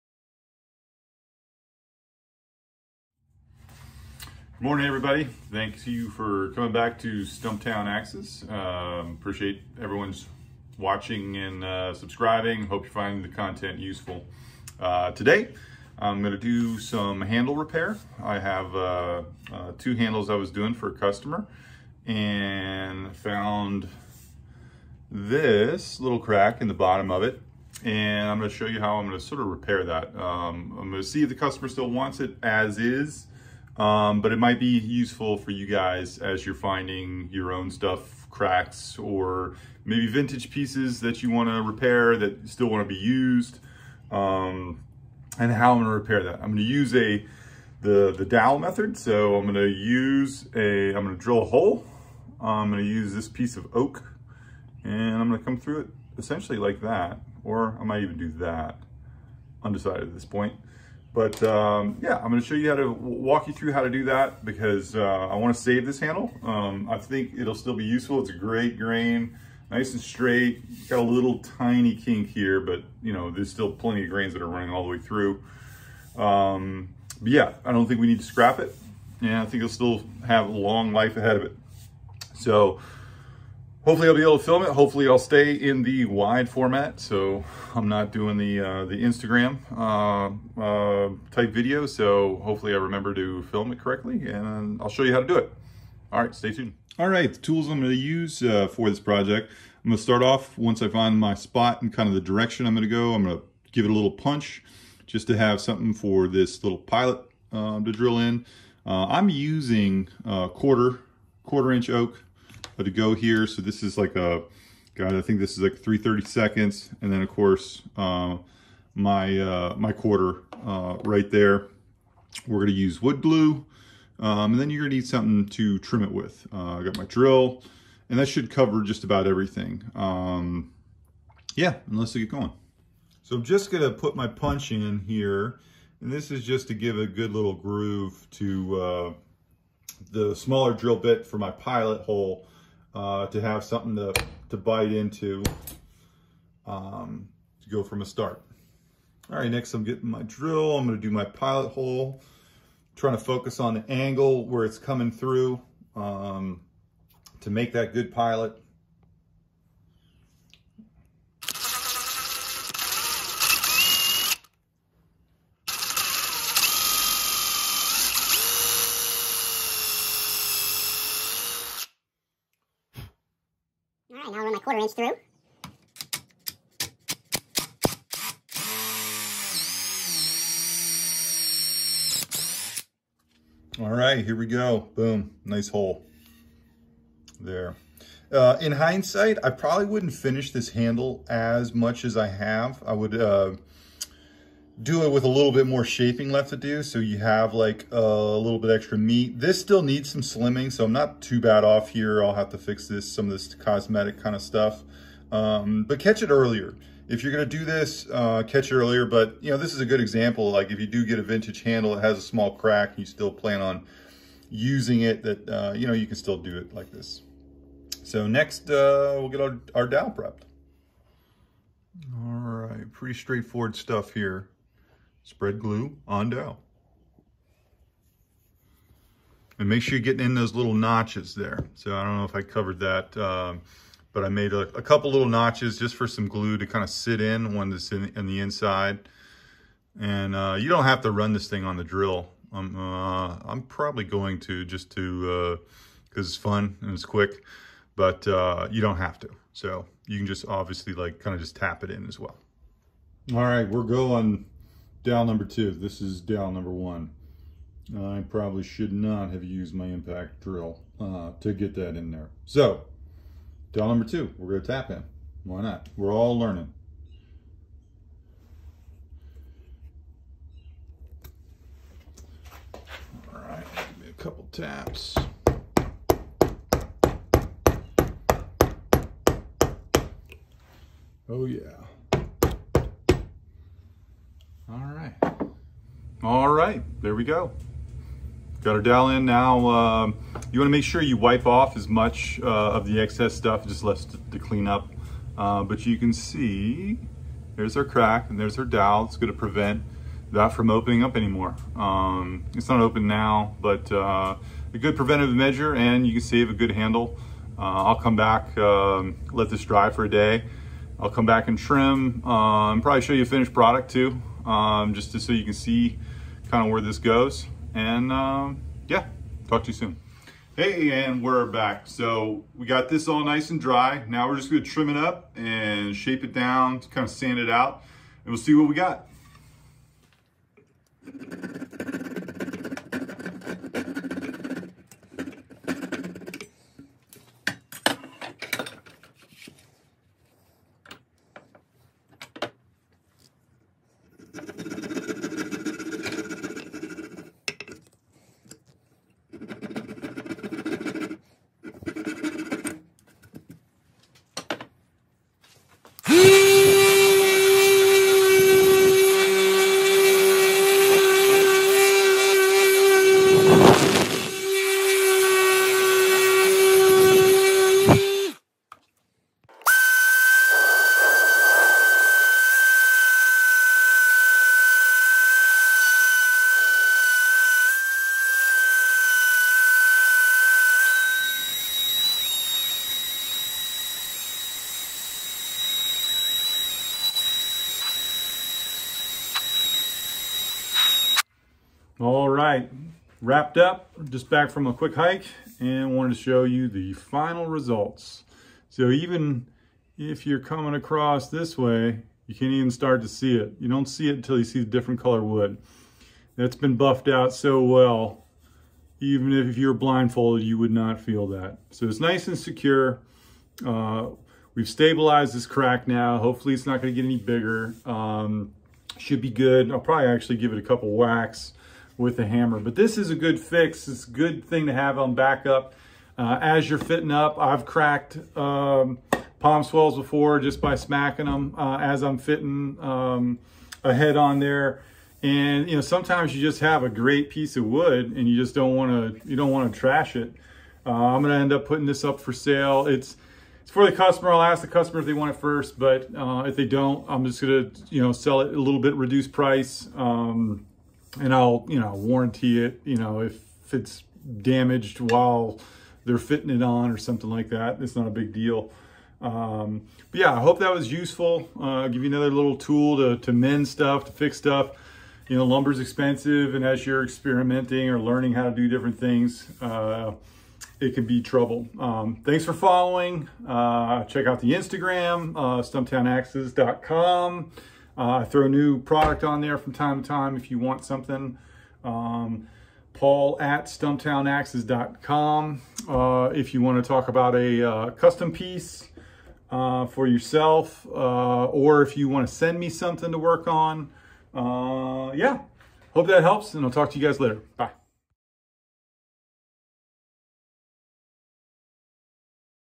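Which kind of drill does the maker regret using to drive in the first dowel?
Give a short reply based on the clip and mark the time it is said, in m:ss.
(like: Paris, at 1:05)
impact drill, at 4:19.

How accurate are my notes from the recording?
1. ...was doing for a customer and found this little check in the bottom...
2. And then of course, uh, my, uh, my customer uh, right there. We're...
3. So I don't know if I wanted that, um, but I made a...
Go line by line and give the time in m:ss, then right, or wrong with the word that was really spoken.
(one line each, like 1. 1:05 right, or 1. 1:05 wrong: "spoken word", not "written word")
1. 0:20 wrong: "crack", not "check"
2. 1:57 wrong: "quarter", not "customer"
3. 3:51 wrong: "covered", not "wanted".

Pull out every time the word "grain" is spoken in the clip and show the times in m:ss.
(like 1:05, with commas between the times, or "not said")
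1:08, 1:14.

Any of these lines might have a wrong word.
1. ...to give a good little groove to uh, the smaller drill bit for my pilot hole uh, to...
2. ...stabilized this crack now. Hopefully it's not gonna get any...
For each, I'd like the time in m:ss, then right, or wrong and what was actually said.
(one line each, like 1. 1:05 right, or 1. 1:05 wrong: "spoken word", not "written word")
1. 2:16 right
2. 6:54 right.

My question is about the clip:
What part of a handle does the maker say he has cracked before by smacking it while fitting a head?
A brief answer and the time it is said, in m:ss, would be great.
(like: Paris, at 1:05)
palm swells, at 7:09.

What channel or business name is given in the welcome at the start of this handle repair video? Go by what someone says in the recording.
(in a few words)
Stumptown Axes.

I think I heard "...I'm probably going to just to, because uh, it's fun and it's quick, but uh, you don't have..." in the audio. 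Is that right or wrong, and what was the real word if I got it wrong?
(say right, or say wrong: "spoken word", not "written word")
right.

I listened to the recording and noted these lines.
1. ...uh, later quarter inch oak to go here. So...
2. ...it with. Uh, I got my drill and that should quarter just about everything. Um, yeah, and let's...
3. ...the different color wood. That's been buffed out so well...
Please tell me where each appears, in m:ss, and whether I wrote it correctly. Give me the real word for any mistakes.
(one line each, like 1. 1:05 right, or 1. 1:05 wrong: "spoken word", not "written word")
1. 1:50 wrong: "quarter", not "later"
2. 2:06 wrong: "cover", not "quarter"
3. 6:44 right.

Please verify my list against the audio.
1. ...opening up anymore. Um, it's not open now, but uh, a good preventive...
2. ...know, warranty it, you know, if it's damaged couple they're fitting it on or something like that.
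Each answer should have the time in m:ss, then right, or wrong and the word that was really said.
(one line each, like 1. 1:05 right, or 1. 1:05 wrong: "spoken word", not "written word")
1. 5:00 right
2. 7:31 wrong: "while", not "couple".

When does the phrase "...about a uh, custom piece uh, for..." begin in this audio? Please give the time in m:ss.
8:07.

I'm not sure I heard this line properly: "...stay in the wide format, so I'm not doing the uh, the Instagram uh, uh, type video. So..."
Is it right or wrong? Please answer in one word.
right.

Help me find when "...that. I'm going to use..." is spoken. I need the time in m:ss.
0:46.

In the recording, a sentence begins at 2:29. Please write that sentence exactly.
All right, next I'm getting my drill.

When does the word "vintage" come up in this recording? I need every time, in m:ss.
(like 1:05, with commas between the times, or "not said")
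0:40, 3:31.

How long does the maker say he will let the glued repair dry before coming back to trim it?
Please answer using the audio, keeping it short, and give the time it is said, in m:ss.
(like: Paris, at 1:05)
a day, at 5:10.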